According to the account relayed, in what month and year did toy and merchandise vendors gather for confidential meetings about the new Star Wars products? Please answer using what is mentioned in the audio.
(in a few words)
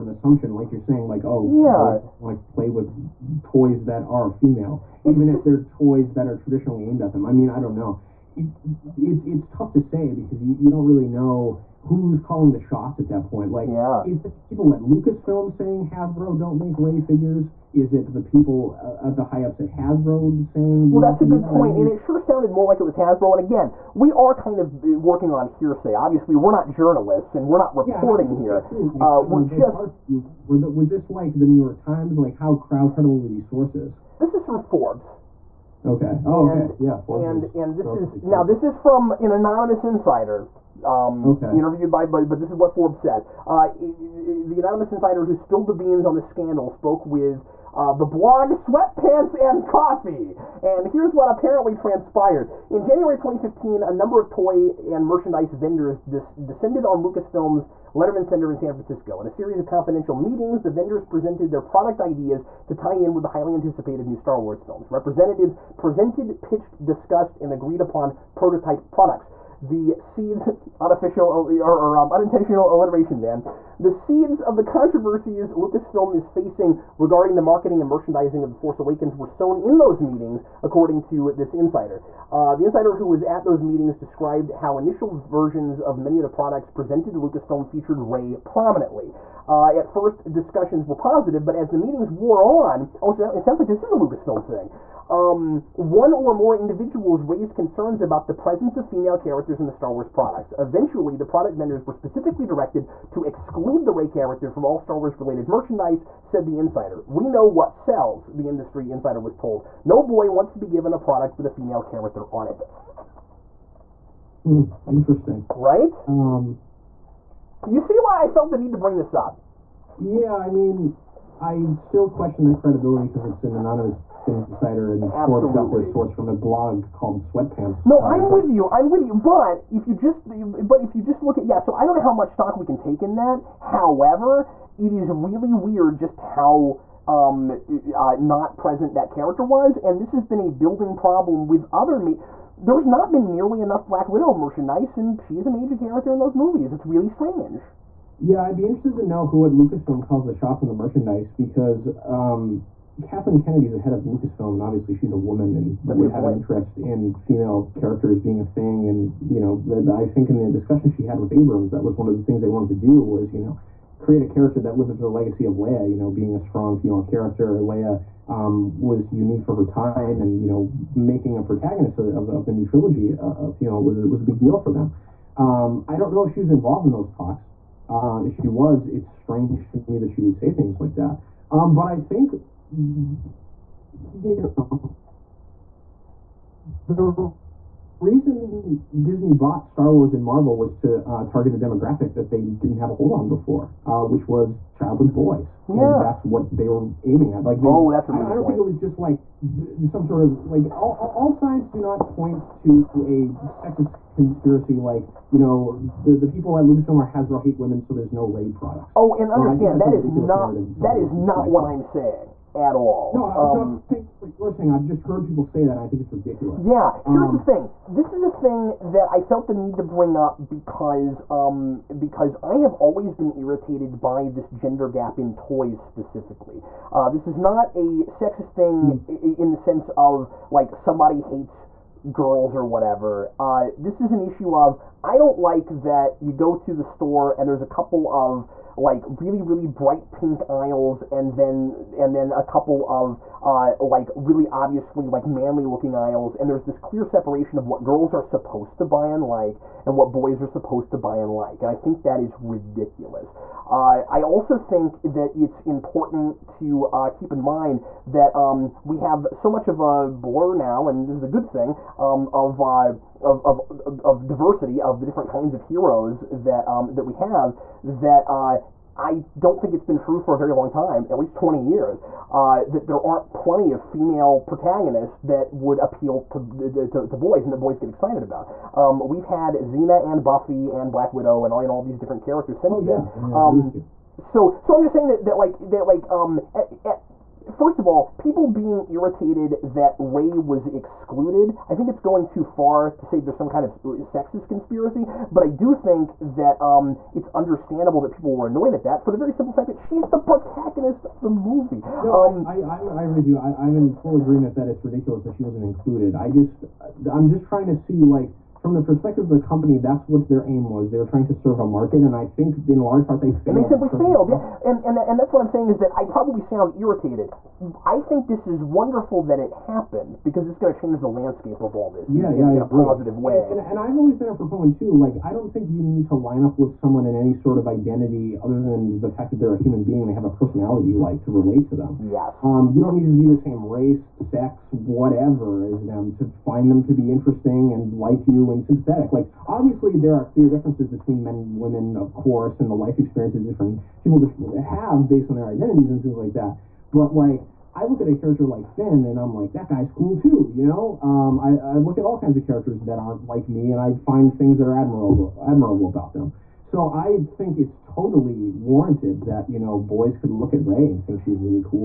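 January 2015.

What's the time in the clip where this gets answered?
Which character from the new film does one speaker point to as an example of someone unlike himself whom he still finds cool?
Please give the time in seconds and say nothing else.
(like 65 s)
348 s.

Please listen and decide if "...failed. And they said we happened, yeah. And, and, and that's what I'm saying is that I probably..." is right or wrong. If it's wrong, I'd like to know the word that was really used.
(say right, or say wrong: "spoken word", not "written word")
wrong: "failed", not "happened".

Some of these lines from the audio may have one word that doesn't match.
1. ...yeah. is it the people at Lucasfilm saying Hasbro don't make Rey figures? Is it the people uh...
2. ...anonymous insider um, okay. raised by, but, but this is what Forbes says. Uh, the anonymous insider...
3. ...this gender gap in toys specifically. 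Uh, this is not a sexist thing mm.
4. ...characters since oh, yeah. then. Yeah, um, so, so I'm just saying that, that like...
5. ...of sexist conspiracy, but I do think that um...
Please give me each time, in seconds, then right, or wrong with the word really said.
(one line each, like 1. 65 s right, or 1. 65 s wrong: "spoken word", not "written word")
1. 13 s right
2. 39 s wrong: "interviewed", not "raised"
3. 224 s right
4. 282 s right
5. 293 s right.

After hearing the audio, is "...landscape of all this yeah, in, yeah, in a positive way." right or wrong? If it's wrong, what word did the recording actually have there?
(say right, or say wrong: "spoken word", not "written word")
right.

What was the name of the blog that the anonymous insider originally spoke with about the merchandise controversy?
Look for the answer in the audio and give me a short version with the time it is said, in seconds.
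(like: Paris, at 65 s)
Sweatpants and Coffee, at 48 s.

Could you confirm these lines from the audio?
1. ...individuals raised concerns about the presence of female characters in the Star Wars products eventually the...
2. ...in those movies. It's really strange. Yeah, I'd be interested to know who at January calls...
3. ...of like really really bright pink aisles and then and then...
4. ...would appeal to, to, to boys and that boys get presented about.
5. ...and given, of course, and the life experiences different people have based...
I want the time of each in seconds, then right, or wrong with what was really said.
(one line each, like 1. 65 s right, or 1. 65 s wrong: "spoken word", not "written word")
1. 96 s right
2. 146 s wrong: "Lucasfilm", not "January"
3. 238 s right
4. 275 s wrong: "excited", not "presented"
5. 341 s wrong: "women", not "given".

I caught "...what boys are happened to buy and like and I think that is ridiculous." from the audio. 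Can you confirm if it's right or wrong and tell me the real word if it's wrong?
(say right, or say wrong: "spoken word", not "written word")
wrong: "supposed", not "happened".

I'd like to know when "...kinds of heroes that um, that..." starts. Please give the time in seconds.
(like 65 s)
265 s.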